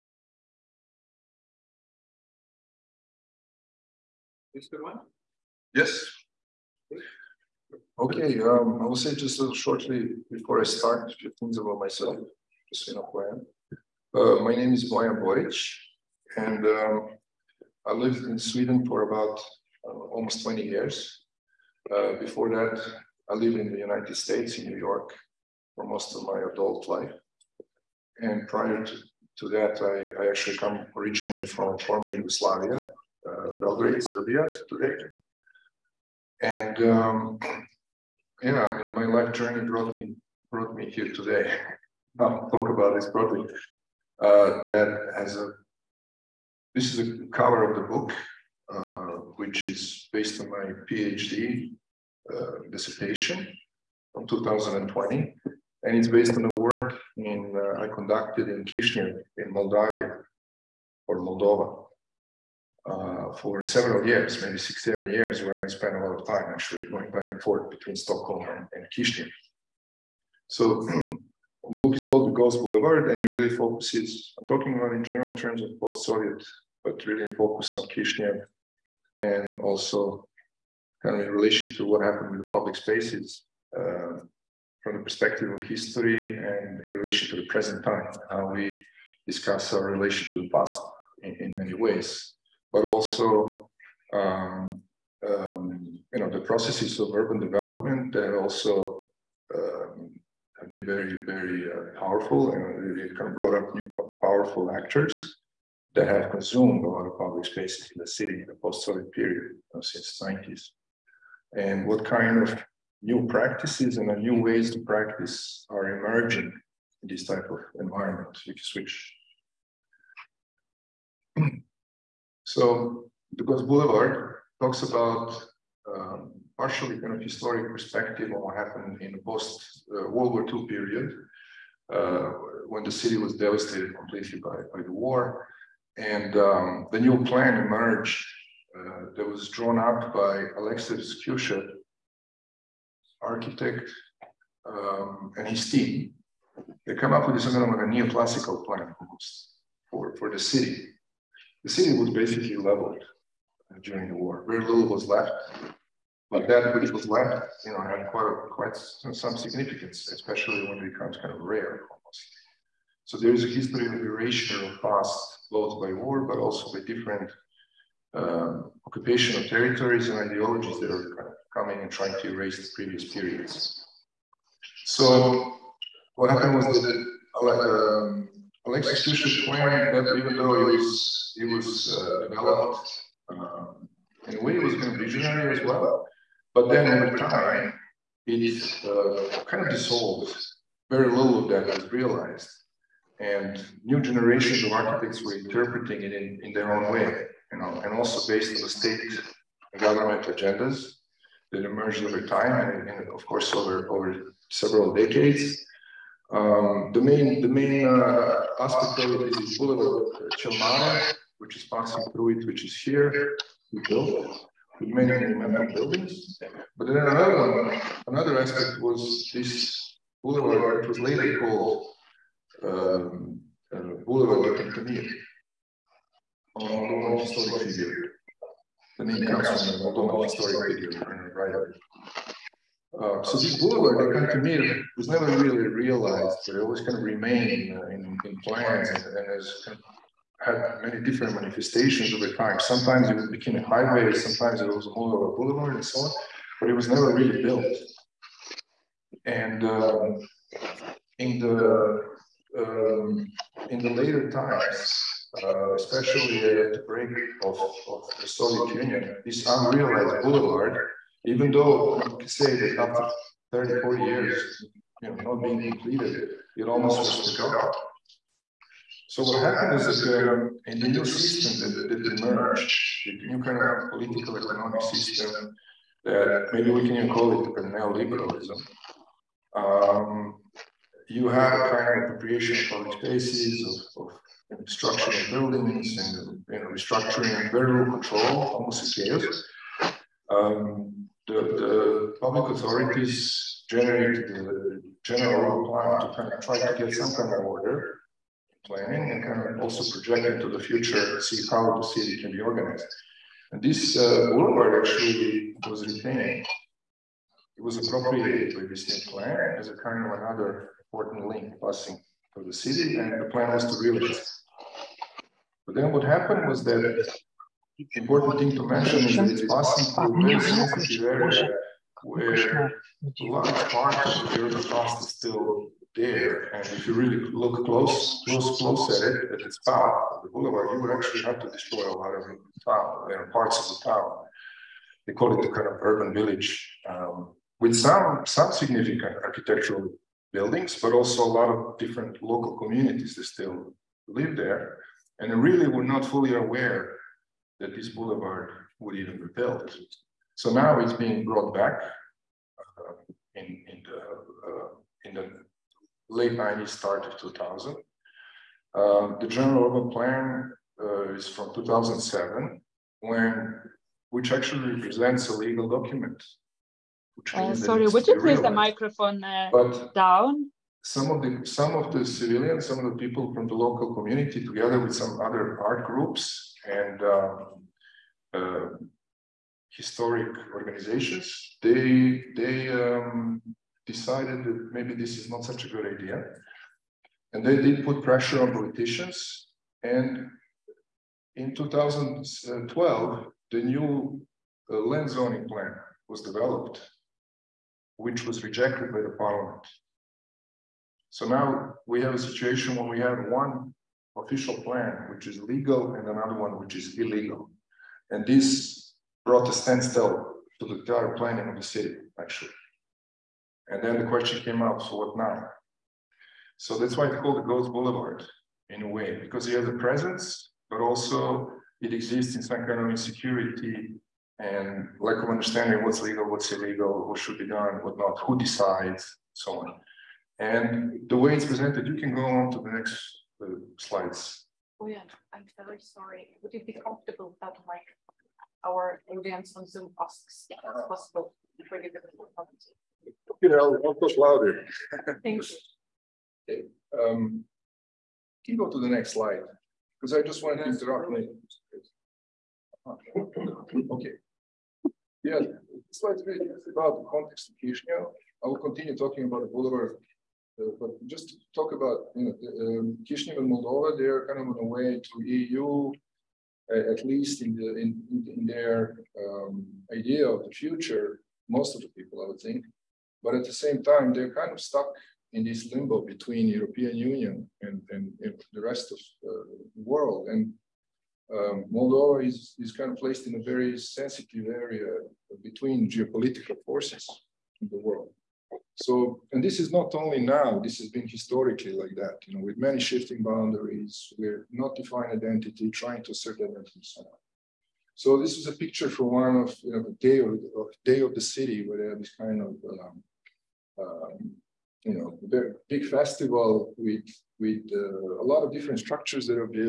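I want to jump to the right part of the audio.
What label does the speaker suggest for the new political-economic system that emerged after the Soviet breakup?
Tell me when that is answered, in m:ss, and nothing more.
4:37.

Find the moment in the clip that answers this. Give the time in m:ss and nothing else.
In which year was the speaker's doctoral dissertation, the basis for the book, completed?
0:54.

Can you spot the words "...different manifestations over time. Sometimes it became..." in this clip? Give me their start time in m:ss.
4:01.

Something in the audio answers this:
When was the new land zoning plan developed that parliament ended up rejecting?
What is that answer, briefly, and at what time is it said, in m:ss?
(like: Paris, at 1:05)
2012, at 6:31.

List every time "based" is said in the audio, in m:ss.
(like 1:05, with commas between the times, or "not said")
0:50, 0:56, 3:18.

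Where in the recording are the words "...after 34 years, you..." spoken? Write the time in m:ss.
4:22.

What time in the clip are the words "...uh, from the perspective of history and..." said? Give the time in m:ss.
1:23.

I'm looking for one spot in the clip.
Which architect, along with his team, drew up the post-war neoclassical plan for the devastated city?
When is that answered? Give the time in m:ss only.
2:20.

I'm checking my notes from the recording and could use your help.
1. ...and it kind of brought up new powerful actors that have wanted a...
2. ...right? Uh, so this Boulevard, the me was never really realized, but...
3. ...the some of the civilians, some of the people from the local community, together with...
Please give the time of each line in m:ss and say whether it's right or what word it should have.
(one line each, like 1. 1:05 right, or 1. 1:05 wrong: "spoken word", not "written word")
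1. 1:42 wrong: "consumed", not "wanted"
2. 3:51 right
3. 6:11 right.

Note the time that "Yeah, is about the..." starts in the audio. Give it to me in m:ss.
7:35.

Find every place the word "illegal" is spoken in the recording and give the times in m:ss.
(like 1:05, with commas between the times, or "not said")
6:46, 7:06.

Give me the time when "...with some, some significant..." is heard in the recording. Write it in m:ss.
5:37.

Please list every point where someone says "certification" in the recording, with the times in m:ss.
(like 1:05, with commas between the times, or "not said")
not said.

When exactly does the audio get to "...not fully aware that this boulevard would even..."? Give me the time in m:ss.
5:45.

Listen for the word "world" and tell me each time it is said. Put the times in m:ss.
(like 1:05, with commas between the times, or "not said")
2:10, 7:59, 8:07.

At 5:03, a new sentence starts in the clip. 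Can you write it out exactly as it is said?
And this uh, boulevard actually was retained.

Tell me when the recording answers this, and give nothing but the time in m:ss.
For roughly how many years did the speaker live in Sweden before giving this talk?
0:19.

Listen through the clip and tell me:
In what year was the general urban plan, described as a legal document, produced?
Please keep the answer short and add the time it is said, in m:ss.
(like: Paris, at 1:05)
2007, at 6:01.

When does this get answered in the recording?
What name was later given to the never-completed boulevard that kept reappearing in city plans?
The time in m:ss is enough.
3:44.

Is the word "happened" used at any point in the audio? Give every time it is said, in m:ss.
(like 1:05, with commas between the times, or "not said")
1:22, 2:08, 2:56, 4:29, 5:16.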